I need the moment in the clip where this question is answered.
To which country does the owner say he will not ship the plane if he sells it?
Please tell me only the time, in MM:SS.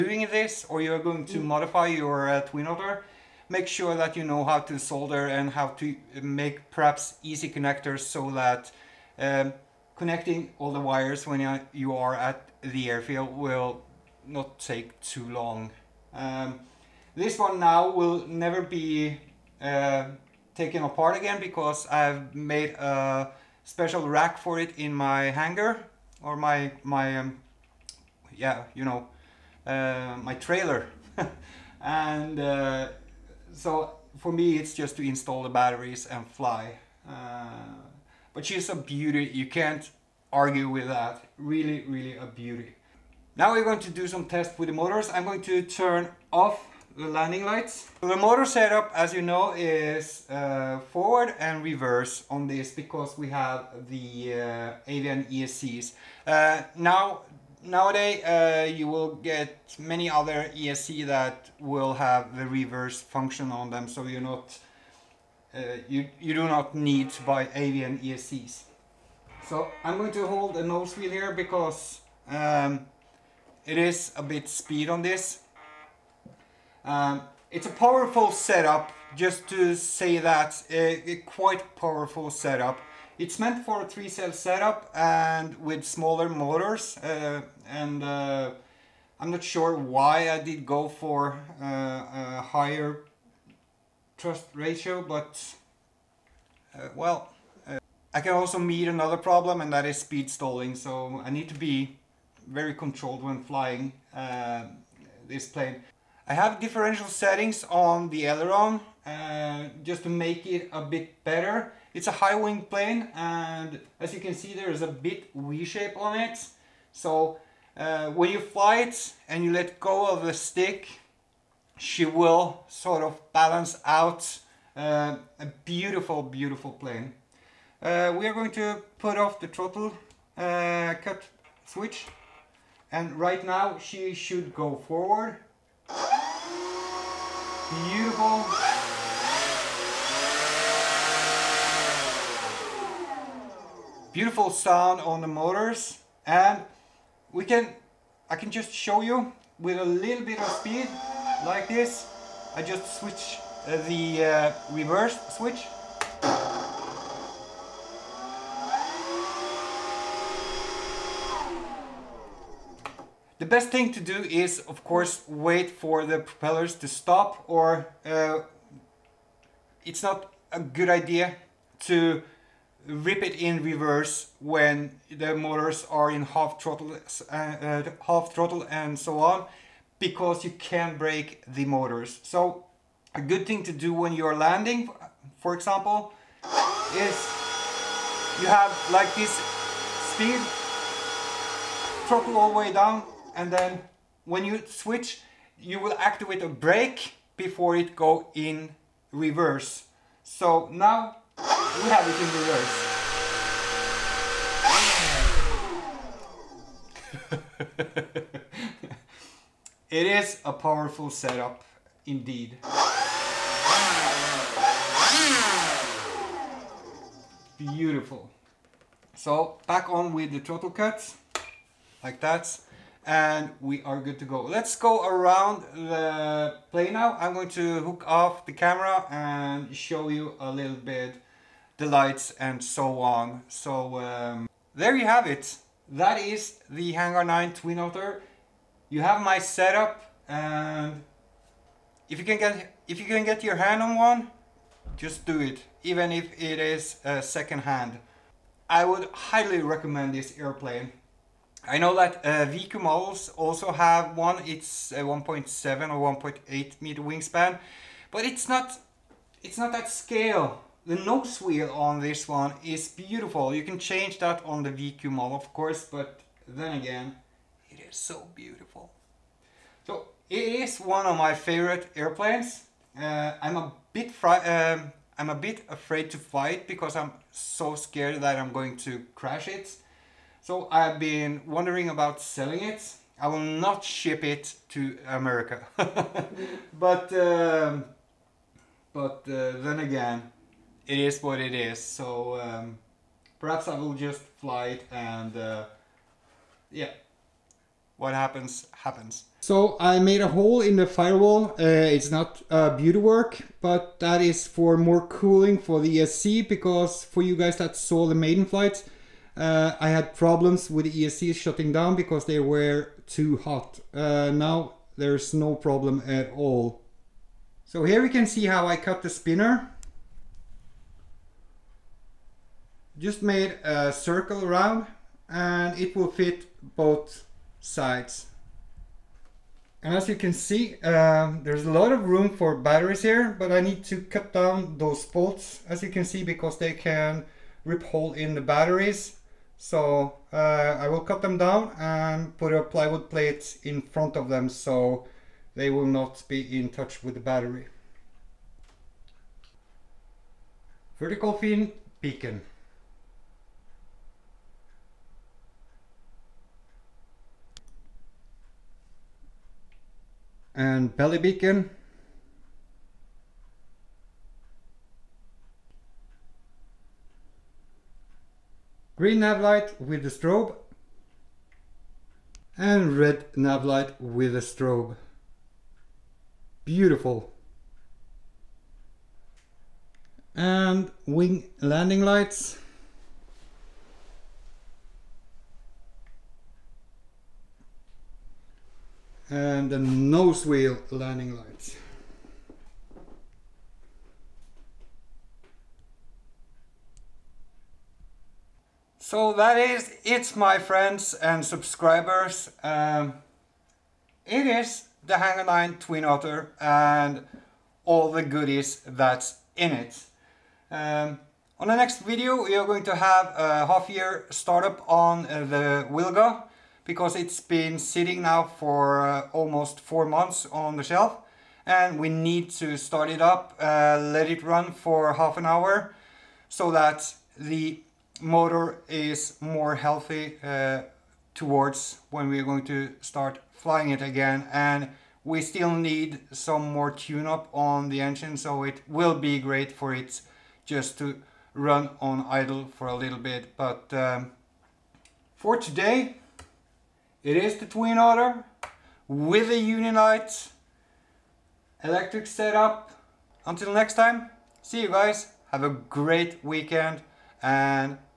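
04:45.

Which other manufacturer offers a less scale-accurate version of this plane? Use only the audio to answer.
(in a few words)
VQ models.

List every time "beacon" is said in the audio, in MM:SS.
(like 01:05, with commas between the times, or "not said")
05:52, 06:01.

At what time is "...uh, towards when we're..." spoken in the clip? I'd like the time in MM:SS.
07:10.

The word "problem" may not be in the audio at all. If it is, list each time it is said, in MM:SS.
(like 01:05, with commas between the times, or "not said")
01:39, 05:10, 05:15.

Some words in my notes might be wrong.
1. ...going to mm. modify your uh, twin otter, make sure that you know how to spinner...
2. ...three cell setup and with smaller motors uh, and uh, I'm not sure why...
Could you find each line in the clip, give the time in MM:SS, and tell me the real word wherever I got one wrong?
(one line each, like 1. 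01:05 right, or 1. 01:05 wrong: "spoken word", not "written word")
1. 00:00 wrong: "solder", not "spinner"
2. 01:23 right.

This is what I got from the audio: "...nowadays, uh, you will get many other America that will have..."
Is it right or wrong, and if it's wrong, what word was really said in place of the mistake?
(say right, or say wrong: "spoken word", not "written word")
wrong: "ESC", not "America".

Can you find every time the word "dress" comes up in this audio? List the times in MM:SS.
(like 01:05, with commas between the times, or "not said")
not said.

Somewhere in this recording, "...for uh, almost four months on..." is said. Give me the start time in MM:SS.
06:58.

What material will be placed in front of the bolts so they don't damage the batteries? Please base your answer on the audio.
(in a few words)
plywood.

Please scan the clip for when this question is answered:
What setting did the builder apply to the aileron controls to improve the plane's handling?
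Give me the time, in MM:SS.
01:46.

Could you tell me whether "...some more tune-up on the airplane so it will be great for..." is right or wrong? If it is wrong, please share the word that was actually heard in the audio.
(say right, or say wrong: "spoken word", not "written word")
wrong: "engine", not "airplane".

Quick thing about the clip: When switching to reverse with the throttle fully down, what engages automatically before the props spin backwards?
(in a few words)
a brake.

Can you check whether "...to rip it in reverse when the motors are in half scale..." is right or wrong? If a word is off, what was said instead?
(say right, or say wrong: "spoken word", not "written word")
wrong: "throttle", not "scale".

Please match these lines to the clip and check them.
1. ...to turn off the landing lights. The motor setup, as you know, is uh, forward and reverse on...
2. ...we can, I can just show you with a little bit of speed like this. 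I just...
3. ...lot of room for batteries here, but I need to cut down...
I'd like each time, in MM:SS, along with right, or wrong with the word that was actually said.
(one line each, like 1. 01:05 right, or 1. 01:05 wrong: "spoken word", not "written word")
1. 00:45 right
2. 02:27 right
3. 05:31 right.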